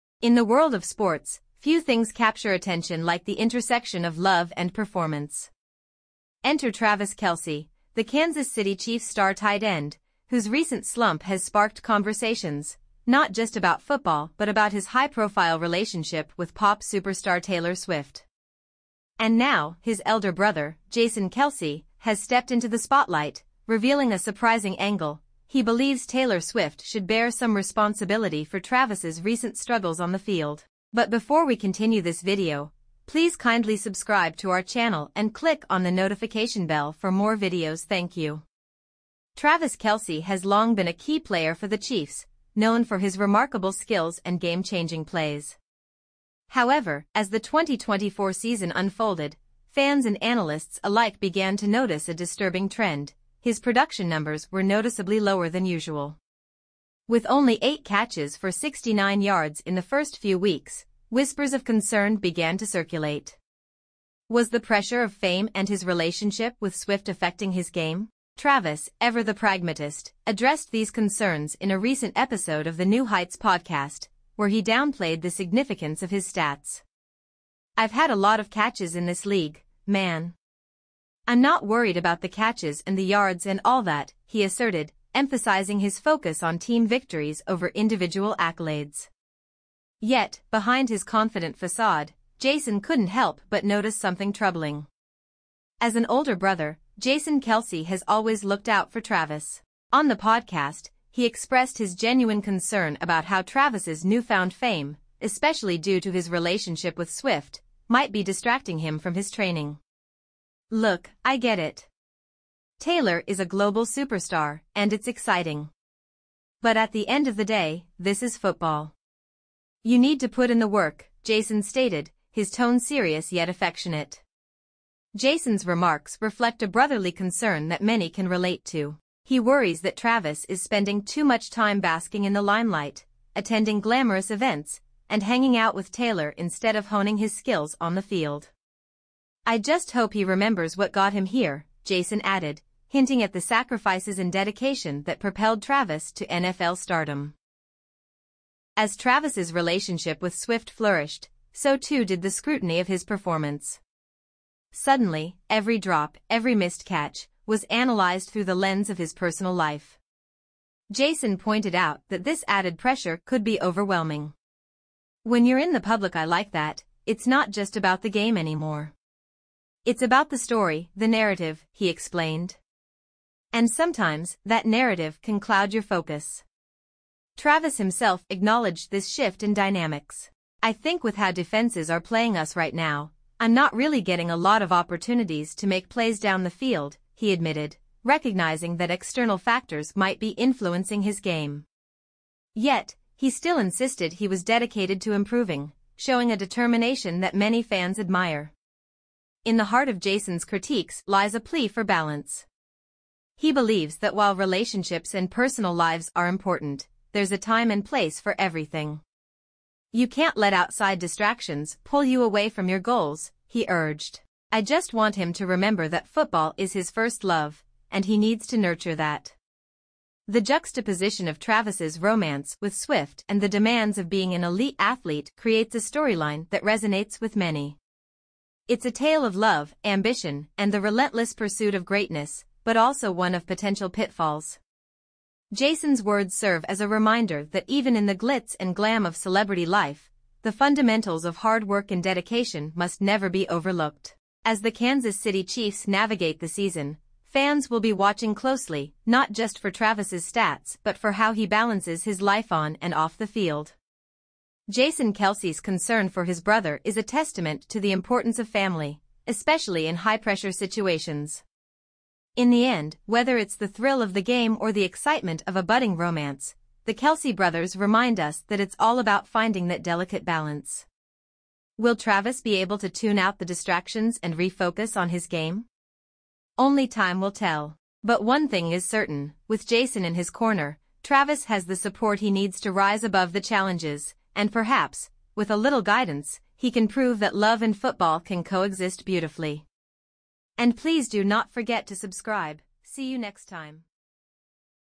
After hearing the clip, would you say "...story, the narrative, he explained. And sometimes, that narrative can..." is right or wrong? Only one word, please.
right.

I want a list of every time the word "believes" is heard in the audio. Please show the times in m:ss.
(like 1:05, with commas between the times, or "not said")
0:25, 3:23.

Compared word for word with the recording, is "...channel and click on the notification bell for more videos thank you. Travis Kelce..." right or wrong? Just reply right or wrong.
right.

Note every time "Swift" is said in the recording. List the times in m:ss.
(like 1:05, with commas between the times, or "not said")
0:17, 0:26, 1:06, 1:47, 2:30, 3:42.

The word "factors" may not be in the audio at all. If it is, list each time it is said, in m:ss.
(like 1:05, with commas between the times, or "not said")
3:09.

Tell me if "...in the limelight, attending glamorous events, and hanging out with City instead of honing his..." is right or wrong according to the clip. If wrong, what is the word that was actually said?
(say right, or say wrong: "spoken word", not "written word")
wrong: "Taylor", not "City".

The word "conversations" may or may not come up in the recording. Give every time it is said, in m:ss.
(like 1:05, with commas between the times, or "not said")
0:11.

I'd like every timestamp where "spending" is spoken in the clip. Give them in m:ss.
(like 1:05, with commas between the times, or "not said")
2:10.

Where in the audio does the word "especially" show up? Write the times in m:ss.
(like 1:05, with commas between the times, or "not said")
1:45, 4:19.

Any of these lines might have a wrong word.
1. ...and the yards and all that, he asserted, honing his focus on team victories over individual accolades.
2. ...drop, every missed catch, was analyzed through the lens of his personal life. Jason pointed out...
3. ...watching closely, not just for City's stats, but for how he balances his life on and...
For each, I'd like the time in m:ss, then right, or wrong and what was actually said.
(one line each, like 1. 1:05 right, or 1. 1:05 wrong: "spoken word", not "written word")
1. 1:22 wrong: "emphasizing", not "honing"
2. 2:35 right
3. 4:07 wrong: "Travis", not "City".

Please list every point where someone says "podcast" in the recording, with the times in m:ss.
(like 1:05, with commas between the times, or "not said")
1:13, 1:40.